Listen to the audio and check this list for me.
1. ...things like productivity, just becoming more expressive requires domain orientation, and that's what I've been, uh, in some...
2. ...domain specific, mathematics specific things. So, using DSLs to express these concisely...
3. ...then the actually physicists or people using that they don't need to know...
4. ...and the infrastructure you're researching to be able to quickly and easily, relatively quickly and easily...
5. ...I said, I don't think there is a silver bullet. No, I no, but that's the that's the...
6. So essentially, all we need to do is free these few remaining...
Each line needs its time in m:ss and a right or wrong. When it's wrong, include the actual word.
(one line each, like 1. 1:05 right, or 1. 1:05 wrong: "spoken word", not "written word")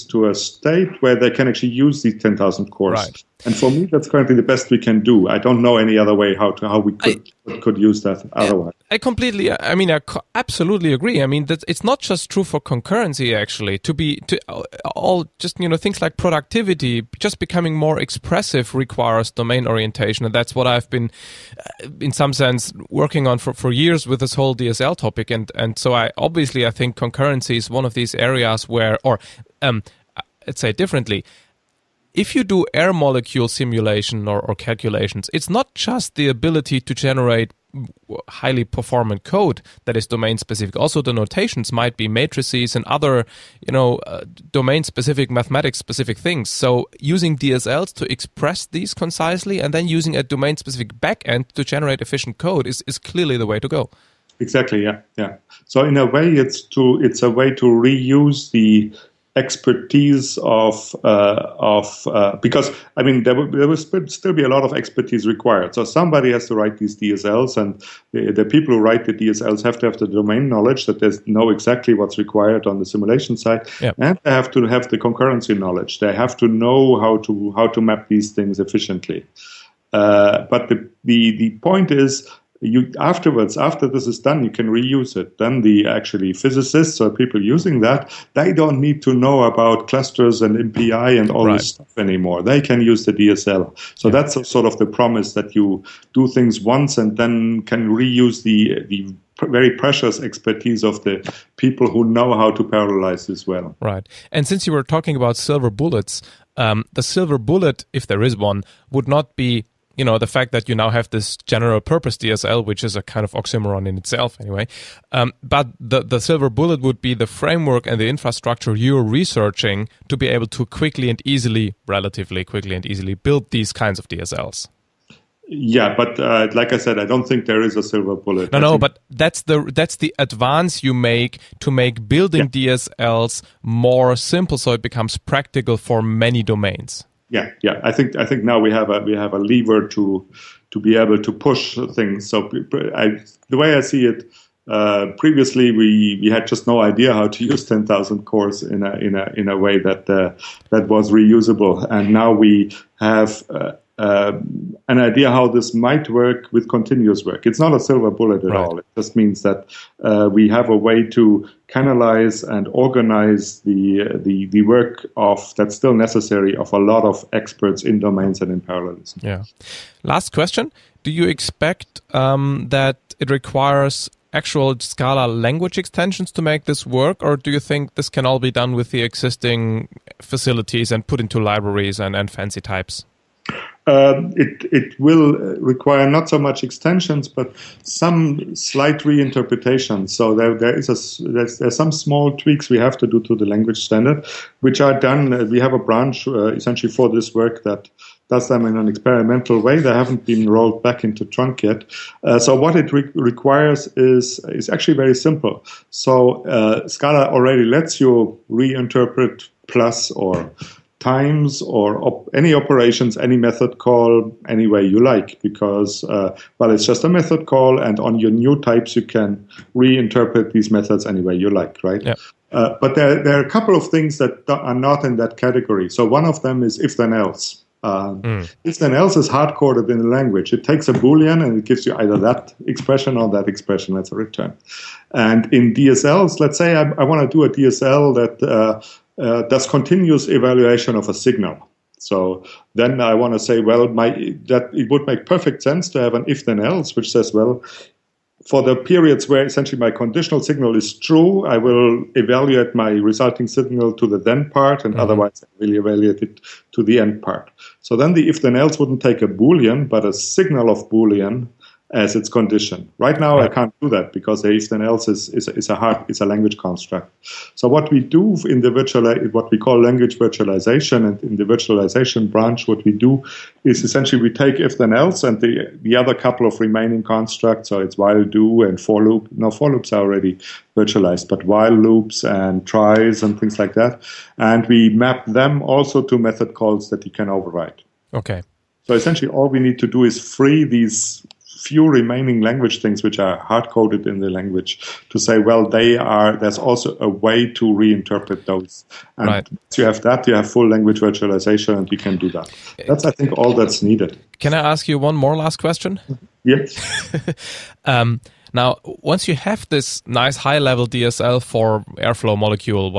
1. 0:15 right
2. 0:44 right
3. 1:25 right
4. 1:57 right
5. 2:06 right
6. 4:48 right.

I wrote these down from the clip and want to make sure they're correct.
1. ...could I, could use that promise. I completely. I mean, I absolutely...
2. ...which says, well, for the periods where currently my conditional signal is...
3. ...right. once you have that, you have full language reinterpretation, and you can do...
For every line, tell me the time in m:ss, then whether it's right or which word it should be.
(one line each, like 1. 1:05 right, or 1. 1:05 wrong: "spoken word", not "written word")
1. 0:06 wrong: "otherwise", not "promise"
2. 4:06 wrong: "essentially", not "currently"
3. 4:59 wrong: "virtualization", not "reinterpretation".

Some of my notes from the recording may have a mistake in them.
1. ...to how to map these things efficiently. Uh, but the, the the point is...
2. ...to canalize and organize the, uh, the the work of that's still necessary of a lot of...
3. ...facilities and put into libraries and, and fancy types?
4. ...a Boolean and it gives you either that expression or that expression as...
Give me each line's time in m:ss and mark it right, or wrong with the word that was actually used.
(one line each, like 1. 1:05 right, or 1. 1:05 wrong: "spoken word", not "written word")
1. 1:17 right
2. 2:41 right
3. 3:00 right
4. 3:50 right.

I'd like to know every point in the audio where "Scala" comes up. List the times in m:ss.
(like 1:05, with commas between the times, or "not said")
2:54, 3:26.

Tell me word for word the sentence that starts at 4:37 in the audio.
So it's while do and for loop.